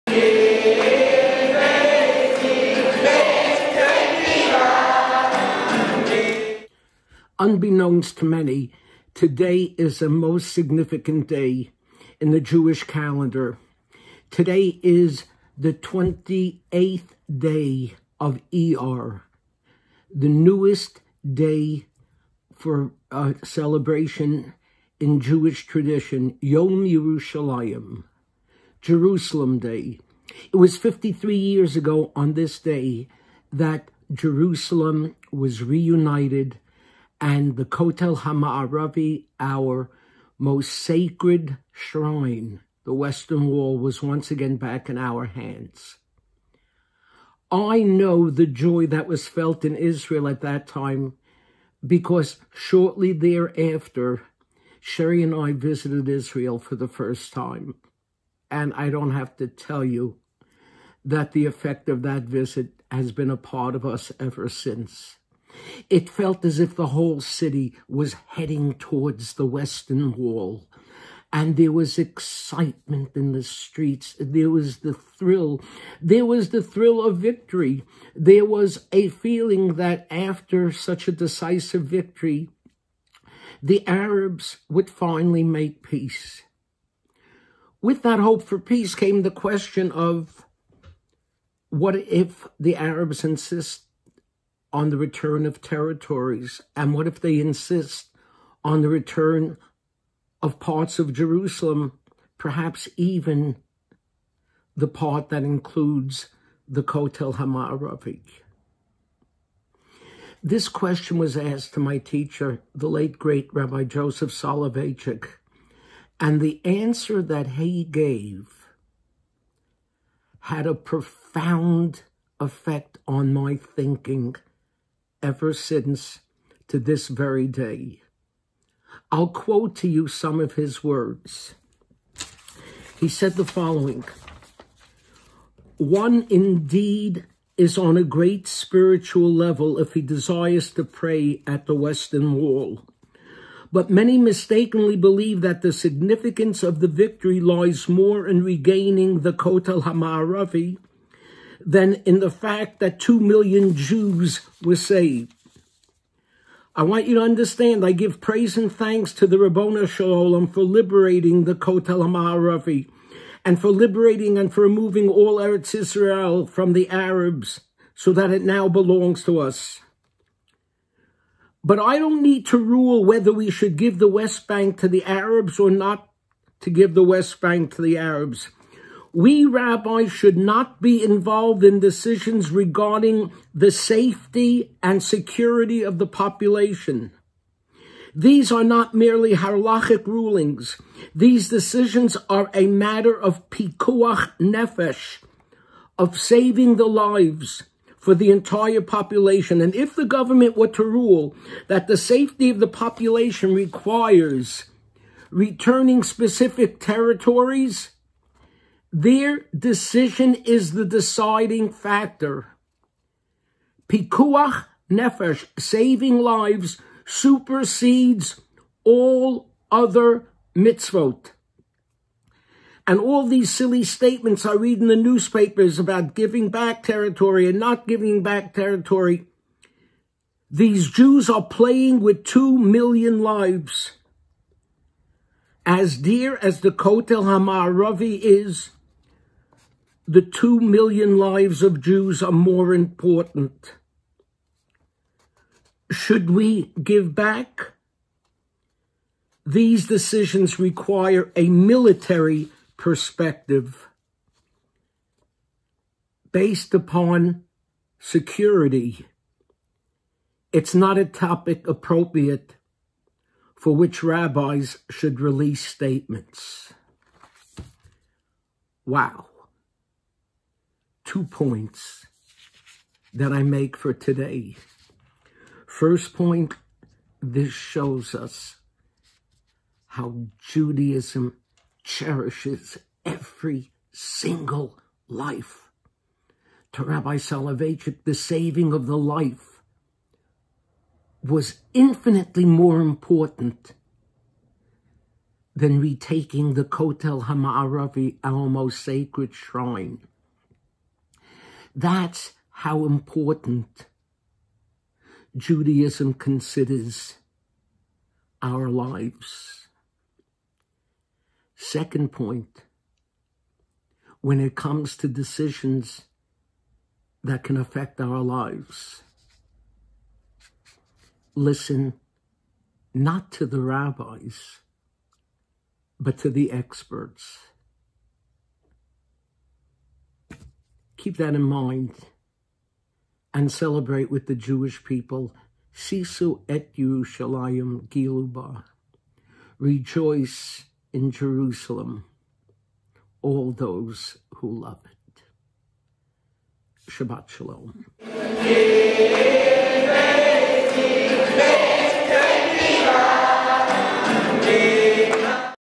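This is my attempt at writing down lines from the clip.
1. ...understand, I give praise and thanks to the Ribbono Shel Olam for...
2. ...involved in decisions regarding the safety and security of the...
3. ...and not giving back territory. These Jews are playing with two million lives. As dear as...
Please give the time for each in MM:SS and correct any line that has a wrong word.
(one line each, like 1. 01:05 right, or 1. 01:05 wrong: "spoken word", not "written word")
1. 02:37 right
2. 03:01 right
3. 03:47 right.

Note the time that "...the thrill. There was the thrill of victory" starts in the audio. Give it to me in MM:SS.
01:14.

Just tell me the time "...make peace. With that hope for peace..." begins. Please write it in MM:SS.
01:25.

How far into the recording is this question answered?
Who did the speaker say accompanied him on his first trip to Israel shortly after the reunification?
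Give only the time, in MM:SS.
00:54.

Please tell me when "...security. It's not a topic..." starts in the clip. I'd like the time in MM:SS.
04:17.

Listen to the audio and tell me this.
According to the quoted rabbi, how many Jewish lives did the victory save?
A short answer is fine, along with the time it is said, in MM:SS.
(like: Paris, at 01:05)
2 million, at 02:32.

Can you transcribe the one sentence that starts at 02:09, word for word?
I'll quote to you some of his words.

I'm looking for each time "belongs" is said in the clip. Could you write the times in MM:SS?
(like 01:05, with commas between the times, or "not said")
02:48.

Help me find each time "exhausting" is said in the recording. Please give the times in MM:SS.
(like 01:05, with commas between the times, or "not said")
not said.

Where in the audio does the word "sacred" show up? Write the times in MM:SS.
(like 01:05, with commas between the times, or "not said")
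00:40, 04:58.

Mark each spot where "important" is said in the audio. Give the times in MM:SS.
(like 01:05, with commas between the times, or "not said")
04:02, 04:52, 05:02.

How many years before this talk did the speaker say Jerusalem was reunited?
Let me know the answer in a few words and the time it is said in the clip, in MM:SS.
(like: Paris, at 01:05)
53, at 00:30.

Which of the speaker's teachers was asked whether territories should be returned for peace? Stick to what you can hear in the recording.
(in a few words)
Rabbi Joseph Soloveitchik.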